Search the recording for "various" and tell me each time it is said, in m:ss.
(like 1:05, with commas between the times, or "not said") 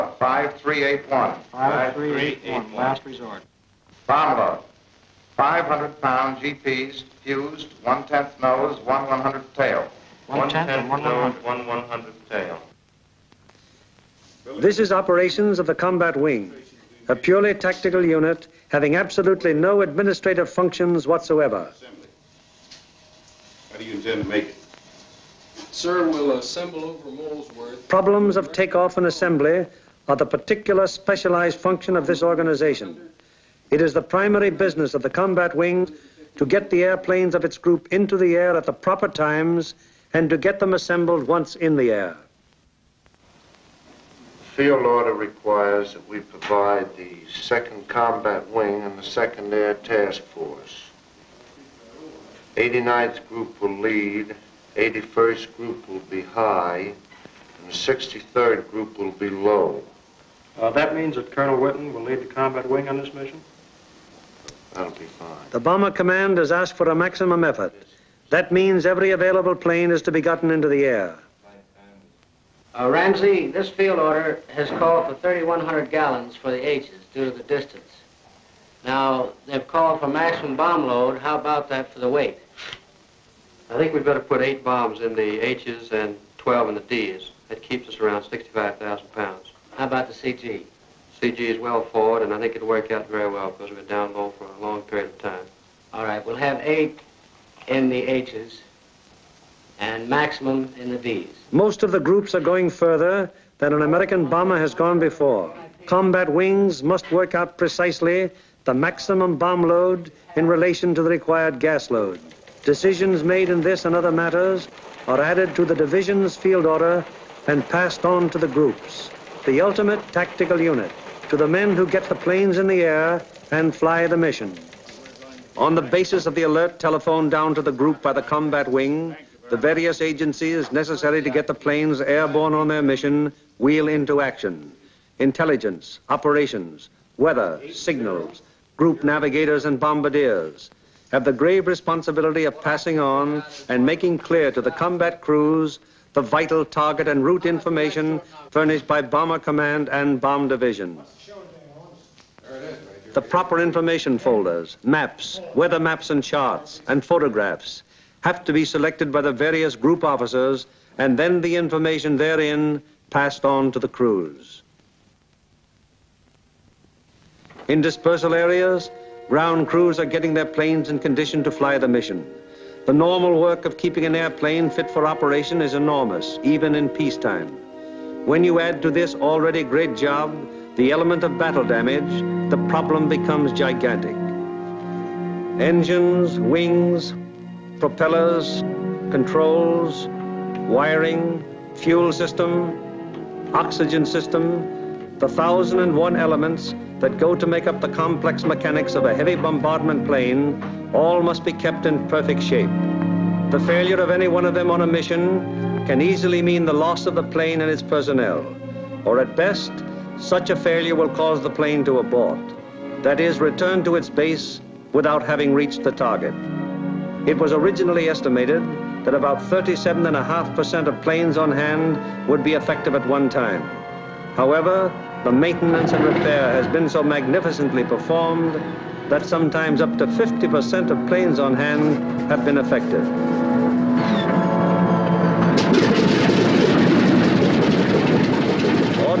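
2:09, 2:39.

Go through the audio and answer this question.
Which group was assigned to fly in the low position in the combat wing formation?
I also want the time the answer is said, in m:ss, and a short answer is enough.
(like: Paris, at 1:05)
63rd Group, at 0:57.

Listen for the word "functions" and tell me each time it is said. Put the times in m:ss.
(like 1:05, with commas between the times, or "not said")
0:20, 0:31.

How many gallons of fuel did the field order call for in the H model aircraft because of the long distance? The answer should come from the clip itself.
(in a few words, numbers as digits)
3,100 gallons.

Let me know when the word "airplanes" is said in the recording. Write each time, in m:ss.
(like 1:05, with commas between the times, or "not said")
0:36, 2:54.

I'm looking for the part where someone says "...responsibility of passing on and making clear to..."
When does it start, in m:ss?
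2:21.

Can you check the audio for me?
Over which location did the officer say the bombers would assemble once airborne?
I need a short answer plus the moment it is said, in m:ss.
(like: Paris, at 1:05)
Molesworth, at 0:27.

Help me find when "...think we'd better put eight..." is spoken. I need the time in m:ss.
1:23.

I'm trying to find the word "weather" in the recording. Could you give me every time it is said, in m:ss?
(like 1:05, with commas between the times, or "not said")
2:17, 2:35.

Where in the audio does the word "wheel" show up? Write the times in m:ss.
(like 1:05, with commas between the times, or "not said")
2:13.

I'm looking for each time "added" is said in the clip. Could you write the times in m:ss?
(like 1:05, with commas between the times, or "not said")
1:55.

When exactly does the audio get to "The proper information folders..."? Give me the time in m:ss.
2:33.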